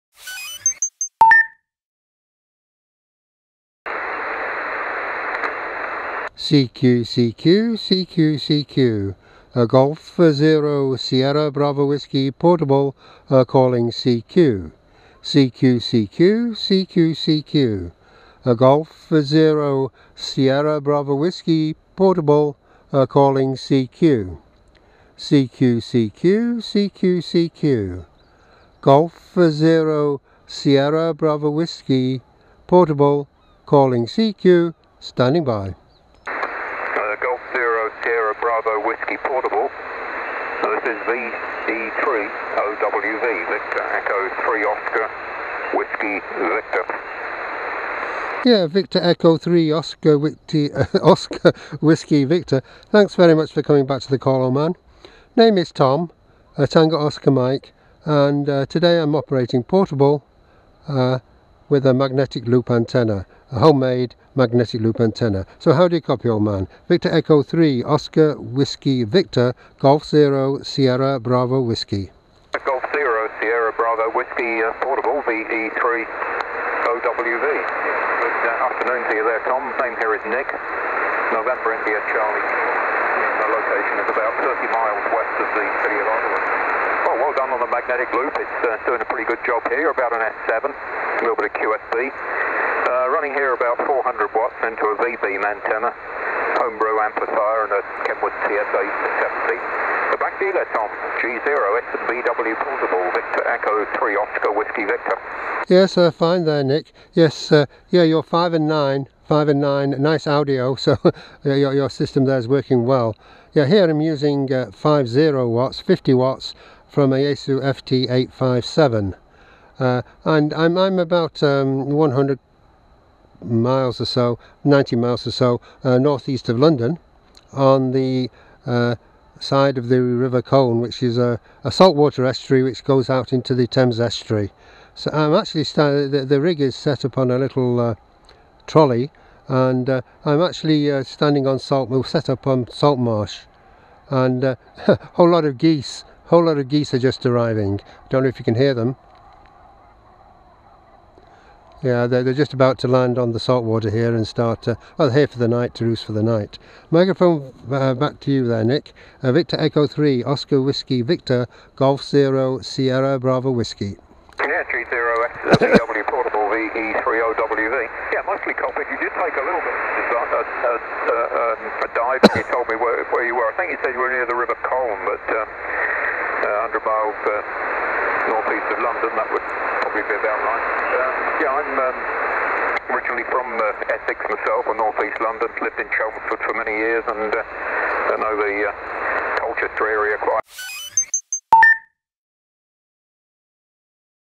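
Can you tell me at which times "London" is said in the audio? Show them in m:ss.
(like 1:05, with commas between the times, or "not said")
2:06, 2:58, 3:05.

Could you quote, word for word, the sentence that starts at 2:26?
A Whole lot of geese are just arriving.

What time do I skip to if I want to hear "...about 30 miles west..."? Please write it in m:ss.
1:24.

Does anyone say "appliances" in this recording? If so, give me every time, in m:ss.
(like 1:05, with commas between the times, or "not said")
not said.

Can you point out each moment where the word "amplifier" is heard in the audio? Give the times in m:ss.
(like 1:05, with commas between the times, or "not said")
1:37.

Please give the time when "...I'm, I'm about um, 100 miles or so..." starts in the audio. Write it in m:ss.
2:00.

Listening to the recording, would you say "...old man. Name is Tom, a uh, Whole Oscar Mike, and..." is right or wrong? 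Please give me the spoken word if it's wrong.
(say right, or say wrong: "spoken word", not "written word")
wrong: "Tango", not "Whole".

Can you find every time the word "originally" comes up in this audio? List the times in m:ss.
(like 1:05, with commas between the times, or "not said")
3:02.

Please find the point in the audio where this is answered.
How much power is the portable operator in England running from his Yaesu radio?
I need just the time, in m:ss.
1:54.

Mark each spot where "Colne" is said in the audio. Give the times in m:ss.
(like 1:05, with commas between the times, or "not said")
2:10, 2:54.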